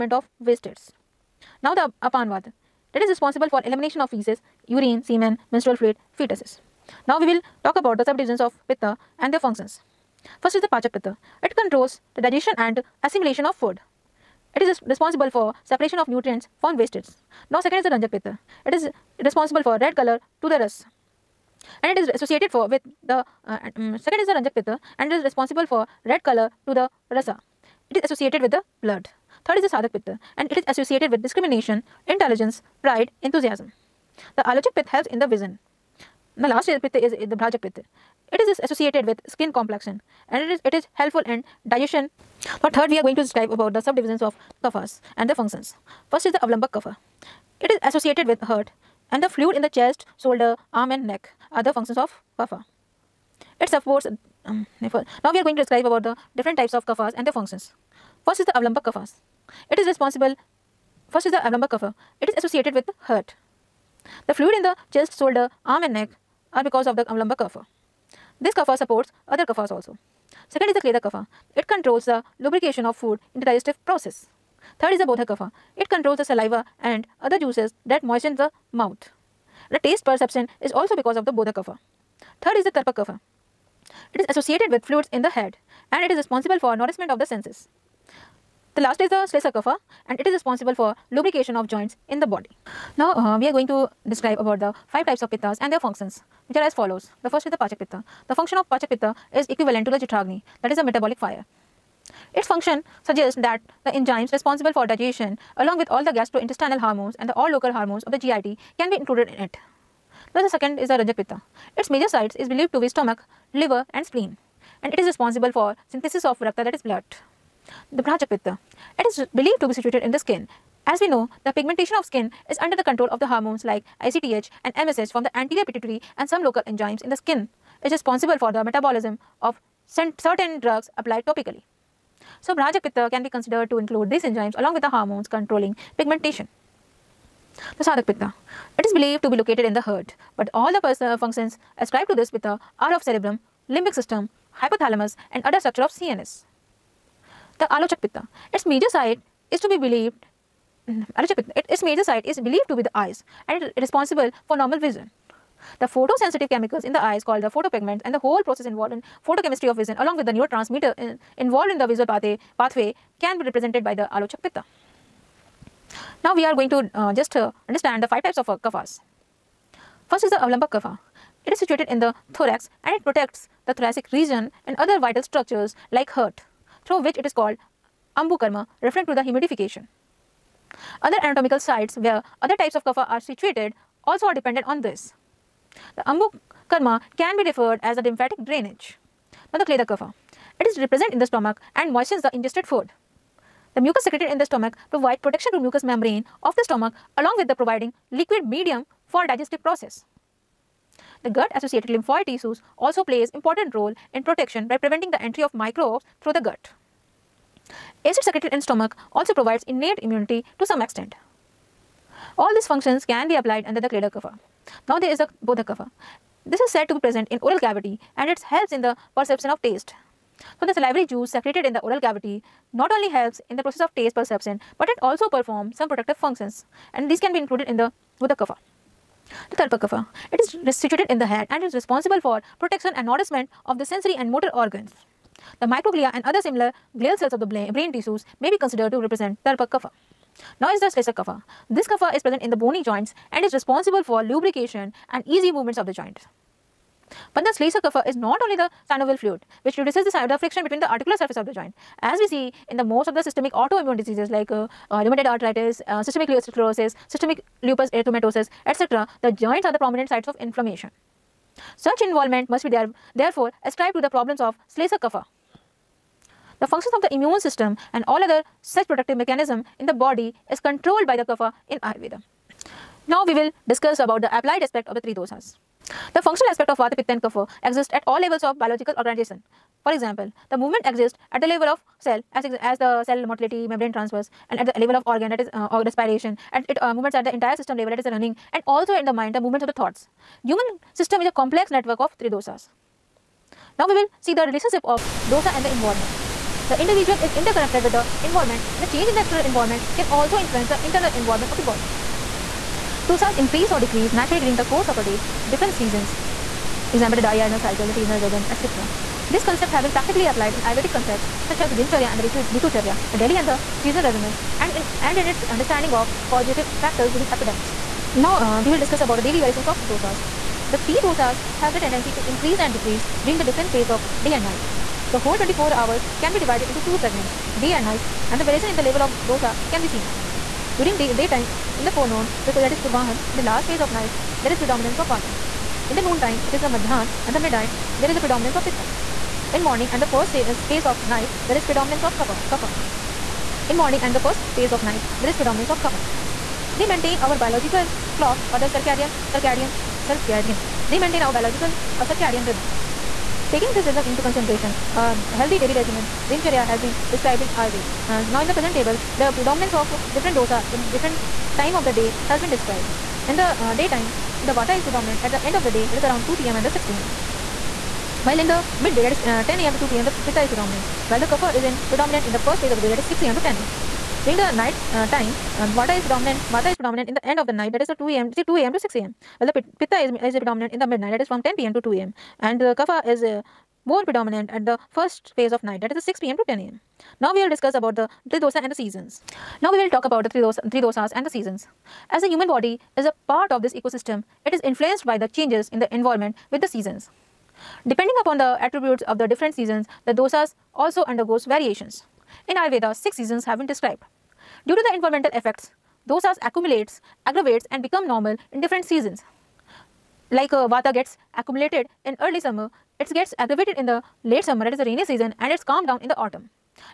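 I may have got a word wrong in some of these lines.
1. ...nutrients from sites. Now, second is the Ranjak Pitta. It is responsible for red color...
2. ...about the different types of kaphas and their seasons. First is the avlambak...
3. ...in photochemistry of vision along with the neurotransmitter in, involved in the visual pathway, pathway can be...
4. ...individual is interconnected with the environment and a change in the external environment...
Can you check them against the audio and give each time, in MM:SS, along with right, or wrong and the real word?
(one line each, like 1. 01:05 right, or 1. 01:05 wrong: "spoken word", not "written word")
1. 00:16 wrong: "wastes", not "sites"
2. 00:55 wrong: "functions", not "seasons"
3. 02:38 right
4. 04:56 right.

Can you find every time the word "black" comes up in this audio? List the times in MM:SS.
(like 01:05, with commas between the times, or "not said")
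not said.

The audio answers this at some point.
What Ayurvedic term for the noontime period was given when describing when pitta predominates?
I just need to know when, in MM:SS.
05:36.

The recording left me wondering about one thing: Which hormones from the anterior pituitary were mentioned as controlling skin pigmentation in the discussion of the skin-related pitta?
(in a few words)
ACTH and MSH.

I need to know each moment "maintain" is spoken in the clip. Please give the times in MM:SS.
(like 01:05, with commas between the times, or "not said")
05:46, 05:50.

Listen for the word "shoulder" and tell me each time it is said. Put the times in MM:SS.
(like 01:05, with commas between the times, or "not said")
00:50, 01:05.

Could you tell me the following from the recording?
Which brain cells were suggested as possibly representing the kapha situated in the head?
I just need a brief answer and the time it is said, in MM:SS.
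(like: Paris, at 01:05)
Microglia, at 03:55.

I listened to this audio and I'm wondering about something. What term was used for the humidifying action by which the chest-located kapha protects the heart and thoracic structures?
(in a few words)
Ambukarma.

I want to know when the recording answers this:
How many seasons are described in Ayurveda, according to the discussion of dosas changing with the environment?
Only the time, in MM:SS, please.
06:42.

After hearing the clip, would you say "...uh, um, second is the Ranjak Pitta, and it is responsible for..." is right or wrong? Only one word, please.
right.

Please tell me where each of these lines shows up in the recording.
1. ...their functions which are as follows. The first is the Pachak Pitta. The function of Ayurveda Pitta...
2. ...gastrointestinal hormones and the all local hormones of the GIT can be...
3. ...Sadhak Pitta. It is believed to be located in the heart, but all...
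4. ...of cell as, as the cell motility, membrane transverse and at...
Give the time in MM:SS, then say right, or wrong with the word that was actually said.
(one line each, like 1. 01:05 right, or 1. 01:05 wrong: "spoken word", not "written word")
1. 01:35 wrong: "Pachak", not "Ayurveda"
2. 01:46 right
3. 02:17 right
4. 04:41 right.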